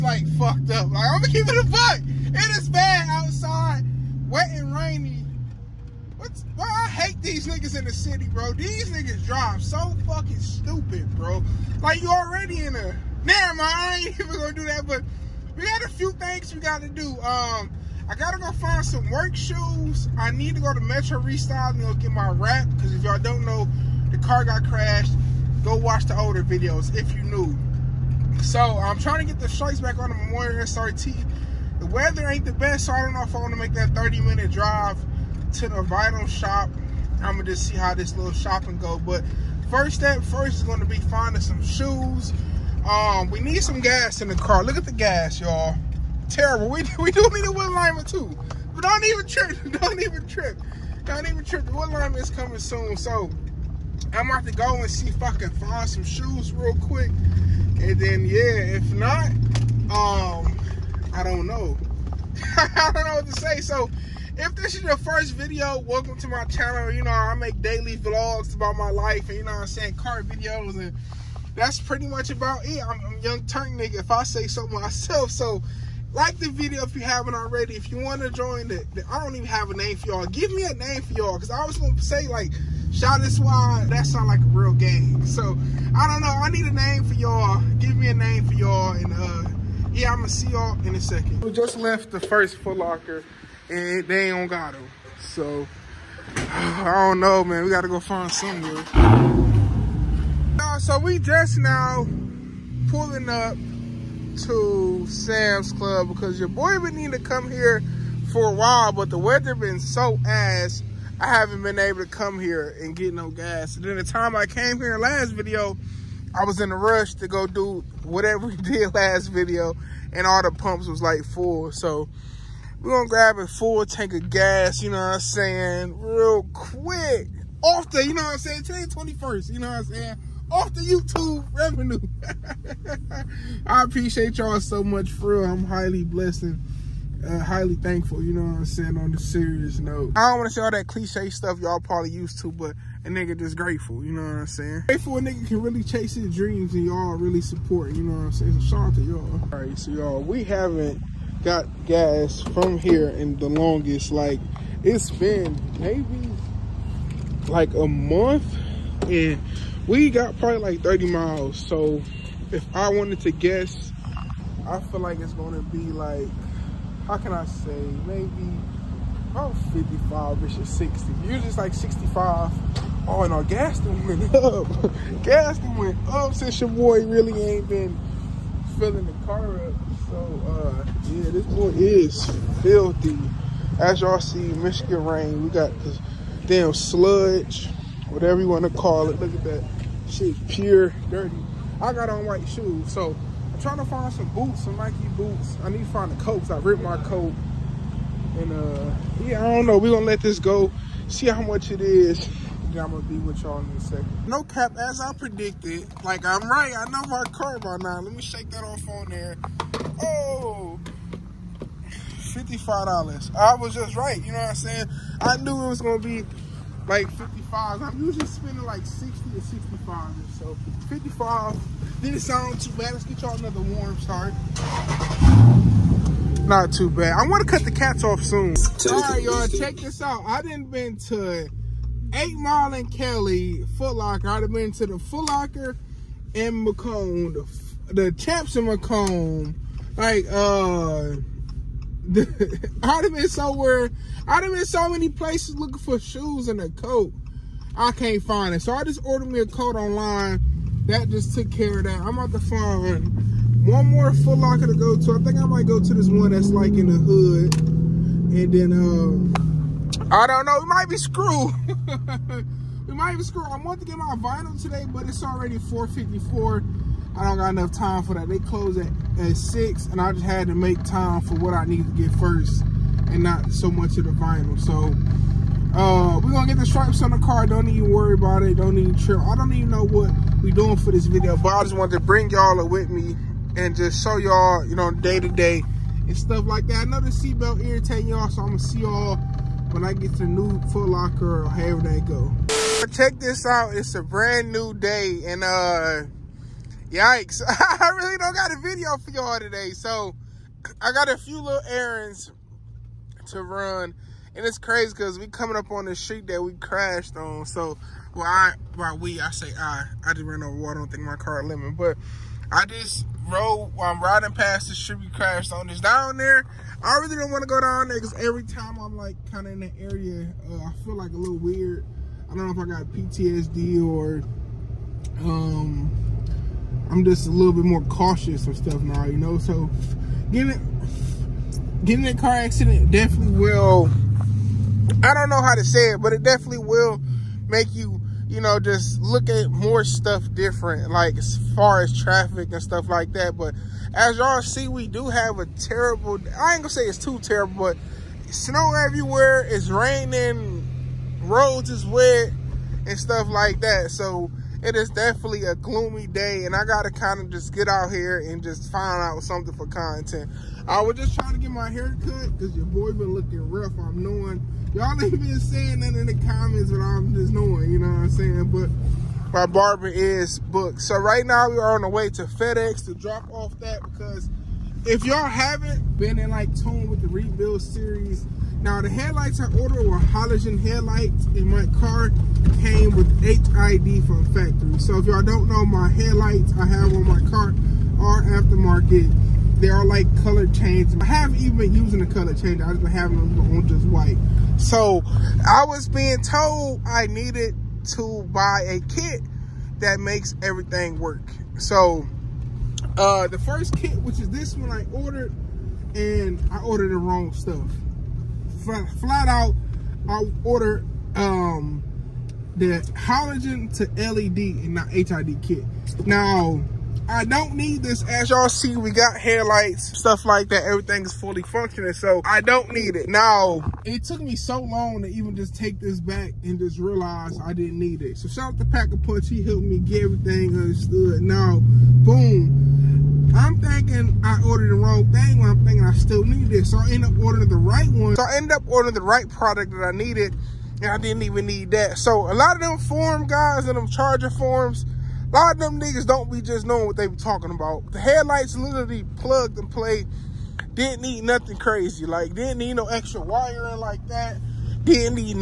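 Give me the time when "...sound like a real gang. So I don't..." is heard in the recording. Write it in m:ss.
1:24.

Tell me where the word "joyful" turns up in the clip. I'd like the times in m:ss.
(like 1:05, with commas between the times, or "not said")
not said.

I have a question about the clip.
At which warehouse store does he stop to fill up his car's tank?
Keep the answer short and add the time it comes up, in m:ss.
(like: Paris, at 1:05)
Sam's Club, at 1:45.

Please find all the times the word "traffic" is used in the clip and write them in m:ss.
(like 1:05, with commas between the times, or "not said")
5:41.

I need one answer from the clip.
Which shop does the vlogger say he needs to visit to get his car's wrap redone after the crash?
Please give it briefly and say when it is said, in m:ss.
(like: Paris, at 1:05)
Metro Restyle, at 0:20.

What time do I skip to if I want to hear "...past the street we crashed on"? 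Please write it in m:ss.
5:14.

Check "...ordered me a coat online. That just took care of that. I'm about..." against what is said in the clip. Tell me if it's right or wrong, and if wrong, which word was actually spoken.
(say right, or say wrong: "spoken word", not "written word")
right.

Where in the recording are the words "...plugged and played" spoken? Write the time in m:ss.
7:29.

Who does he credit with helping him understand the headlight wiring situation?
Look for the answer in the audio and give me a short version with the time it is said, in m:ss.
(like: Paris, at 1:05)
Pack A Punch, at 7:08.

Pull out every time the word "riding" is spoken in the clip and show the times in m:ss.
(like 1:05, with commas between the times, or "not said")
5:14.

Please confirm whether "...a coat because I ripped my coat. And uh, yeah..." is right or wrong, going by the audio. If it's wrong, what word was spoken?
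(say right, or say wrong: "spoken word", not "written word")
right.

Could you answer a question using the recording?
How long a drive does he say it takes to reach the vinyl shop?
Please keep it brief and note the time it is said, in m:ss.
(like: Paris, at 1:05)
30 minute, at 0:33.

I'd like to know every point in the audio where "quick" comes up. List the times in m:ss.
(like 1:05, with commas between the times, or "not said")
0:56, 2:06.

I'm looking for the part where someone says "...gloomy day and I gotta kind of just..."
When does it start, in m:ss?
5:55.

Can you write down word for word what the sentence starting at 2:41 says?
So if I wanted to guess, I feel like it's gonna be like how can I say, maybe about 55-ish or 60.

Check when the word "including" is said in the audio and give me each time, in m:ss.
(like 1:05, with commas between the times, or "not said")
not said.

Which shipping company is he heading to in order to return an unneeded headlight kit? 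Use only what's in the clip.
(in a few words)
FedEx.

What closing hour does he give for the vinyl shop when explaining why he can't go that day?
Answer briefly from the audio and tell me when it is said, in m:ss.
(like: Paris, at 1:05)
6, at 4:29.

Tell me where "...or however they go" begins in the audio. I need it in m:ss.
4:51.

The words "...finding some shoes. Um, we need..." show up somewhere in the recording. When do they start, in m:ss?
0:40.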